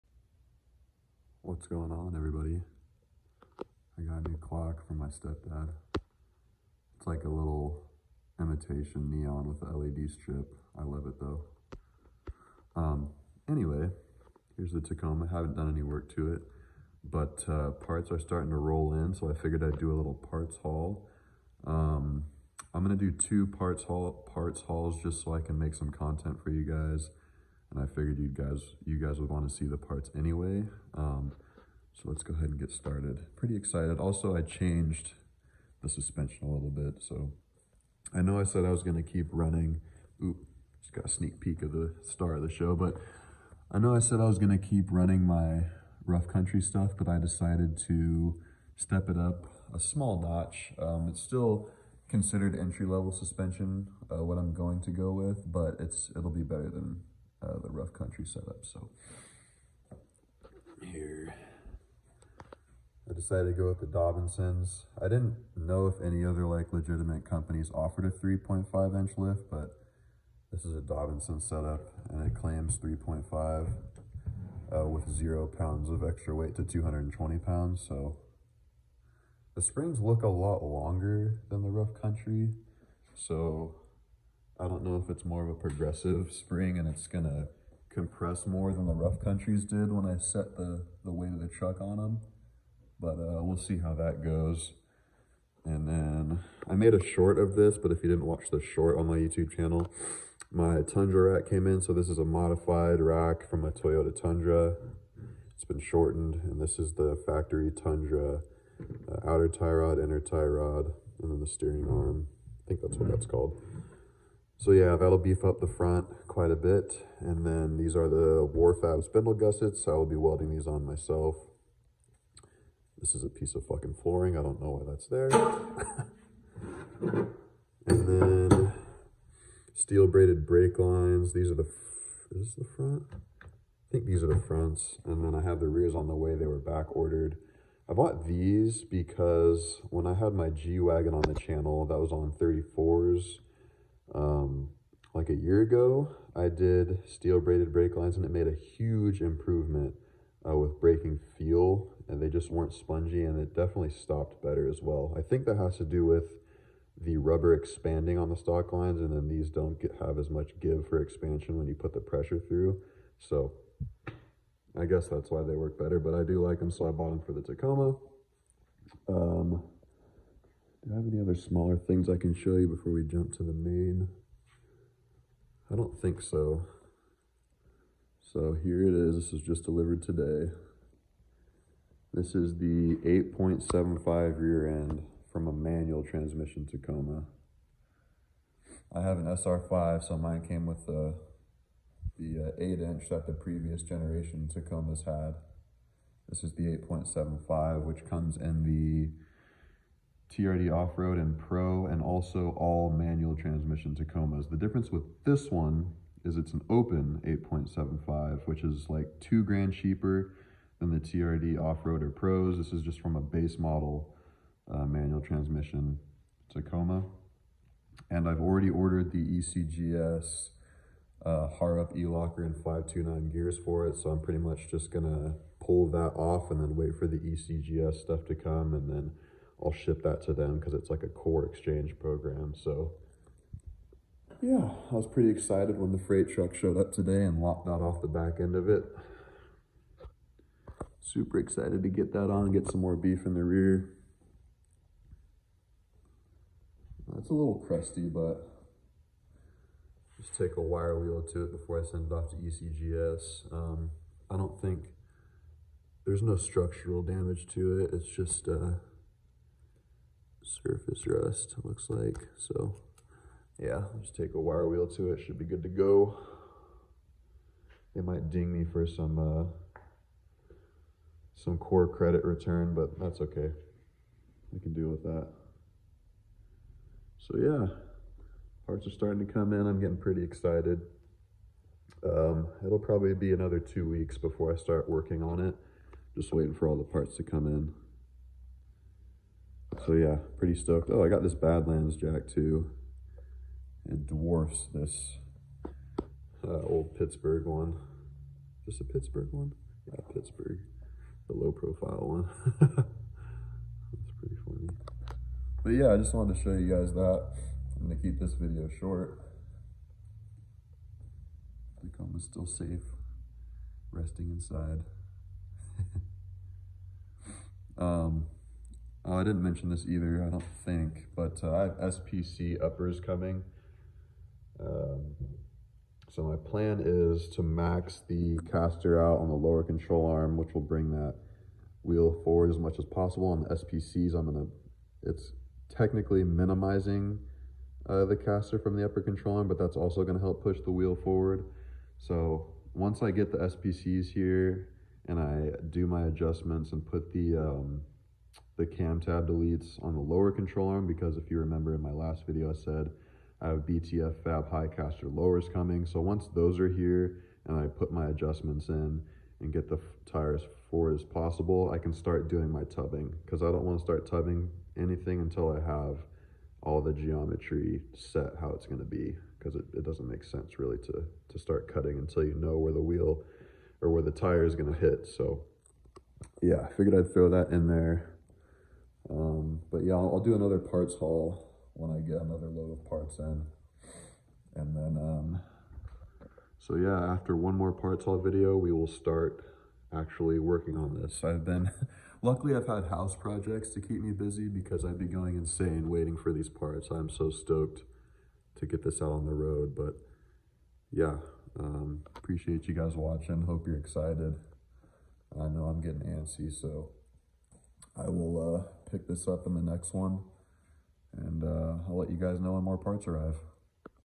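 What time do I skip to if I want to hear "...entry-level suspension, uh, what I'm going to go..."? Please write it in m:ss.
0:52.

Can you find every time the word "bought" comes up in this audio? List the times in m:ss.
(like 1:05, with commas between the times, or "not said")
2:17, 2:46.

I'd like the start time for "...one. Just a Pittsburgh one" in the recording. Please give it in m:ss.
4:57.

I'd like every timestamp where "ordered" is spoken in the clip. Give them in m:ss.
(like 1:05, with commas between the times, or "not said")
2:16, 3:38.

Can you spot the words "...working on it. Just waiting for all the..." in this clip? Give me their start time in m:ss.
4:44.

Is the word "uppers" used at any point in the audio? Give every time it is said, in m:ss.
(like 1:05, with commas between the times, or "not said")
5:22, 5:38.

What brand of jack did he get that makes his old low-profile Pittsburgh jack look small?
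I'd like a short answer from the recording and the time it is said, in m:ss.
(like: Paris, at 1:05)
Badlands, at 4:51.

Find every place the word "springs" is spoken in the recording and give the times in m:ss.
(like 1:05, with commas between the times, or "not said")
1:19, 1:26.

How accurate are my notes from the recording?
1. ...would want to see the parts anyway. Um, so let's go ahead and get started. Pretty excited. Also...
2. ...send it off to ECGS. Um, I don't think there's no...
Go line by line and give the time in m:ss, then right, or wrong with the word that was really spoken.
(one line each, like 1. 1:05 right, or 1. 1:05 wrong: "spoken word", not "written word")
1. 0:29 right
2. 4:11 right.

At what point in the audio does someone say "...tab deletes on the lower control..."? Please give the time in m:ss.
5:48.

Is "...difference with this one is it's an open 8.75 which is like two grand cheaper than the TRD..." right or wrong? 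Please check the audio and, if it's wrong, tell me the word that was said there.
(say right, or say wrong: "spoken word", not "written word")
right.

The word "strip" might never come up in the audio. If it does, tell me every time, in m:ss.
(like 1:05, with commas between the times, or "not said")
0:10.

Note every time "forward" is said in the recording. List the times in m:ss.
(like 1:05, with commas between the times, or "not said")
5:32, 5:40, 6:00.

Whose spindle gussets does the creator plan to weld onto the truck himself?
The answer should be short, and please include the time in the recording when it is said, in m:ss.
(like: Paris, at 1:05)
Warfab, at 1:58.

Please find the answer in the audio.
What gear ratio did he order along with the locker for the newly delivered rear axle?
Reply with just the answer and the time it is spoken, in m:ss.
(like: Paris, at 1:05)
5.29, at 3:42.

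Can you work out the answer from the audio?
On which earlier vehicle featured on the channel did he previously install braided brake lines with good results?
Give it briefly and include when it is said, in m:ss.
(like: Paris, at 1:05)
G-Wagon, at 2:20.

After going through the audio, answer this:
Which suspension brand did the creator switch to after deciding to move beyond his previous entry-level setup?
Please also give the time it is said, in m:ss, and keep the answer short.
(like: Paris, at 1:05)
Dobinsons, at 1:03.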